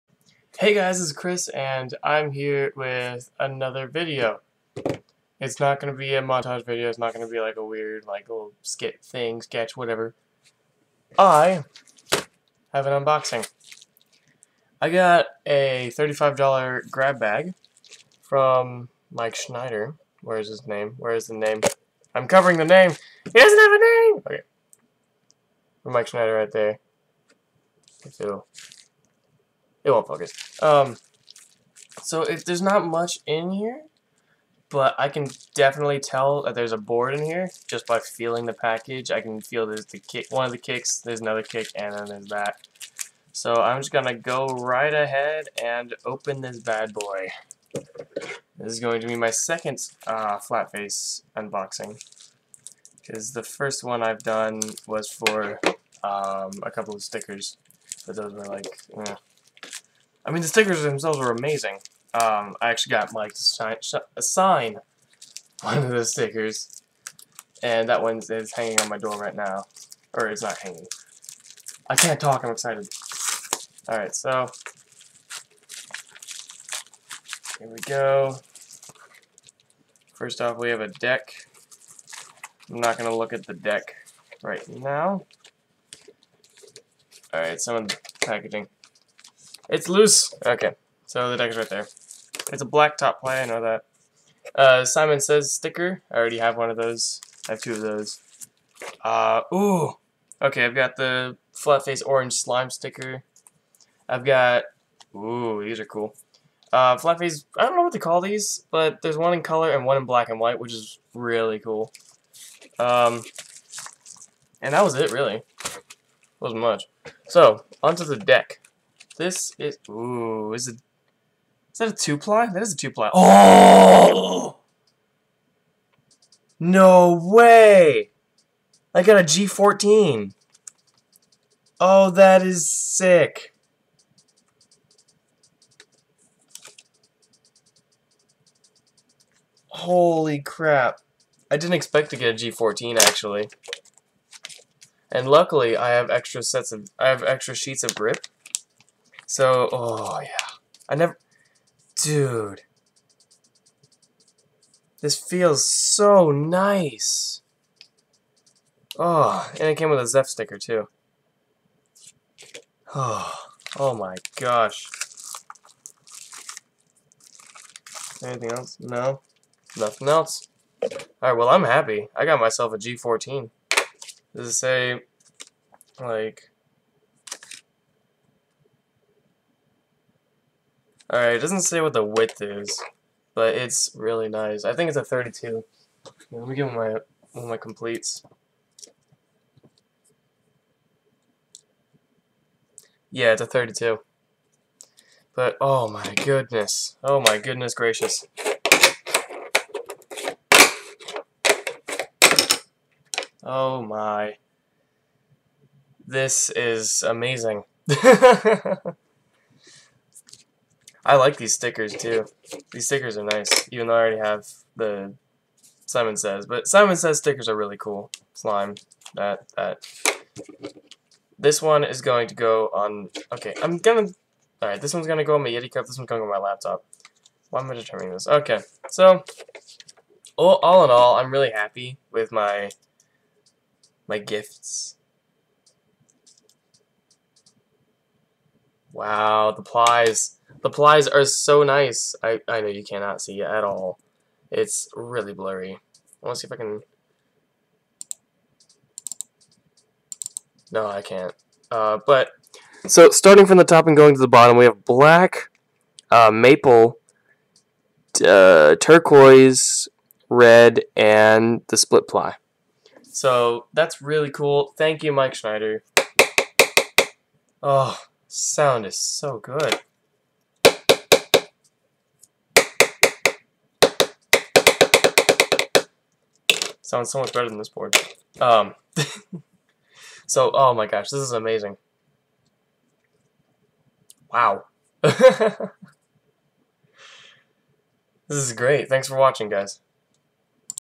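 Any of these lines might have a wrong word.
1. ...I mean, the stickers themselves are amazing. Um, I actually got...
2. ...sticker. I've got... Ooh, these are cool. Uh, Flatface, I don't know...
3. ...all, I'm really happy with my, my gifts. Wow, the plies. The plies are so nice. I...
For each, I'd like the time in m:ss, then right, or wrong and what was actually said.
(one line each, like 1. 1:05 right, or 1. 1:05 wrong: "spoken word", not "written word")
1. 1:00 right
2. 1:42 right
3. 3:50 right.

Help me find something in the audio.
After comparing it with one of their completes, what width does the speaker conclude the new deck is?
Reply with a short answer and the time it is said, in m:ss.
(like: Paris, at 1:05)
32, at 3:13.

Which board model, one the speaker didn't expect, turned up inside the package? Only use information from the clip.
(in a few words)
G14.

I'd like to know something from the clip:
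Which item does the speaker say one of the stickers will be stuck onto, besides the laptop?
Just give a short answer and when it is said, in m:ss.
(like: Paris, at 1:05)
Yeti cup, at 3:45.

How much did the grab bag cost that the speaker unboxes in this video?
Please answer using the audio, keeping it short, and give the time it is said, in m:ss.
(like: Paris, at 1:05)
$35, at 0:15.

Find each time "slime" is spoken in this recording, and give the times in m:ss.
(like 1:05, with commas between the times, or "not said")
1:42, 3:38.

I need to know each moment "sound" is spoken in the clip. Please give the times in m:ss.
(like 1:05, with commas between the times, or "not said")
4:28, 4:36.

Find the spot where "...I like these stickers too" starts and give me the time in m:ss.
3:31.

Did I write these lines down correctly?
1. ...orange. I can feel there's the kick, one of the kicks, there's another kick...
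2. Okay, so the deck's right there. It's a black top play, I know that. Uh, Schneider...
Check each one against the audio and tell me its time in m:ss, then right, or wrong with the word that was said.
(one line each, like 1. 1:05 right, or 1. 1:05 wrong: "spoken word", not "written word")
1. 0:38 wrong: "package", not "orange"
2. 1:30 wrong: "Simon", not "Schneider".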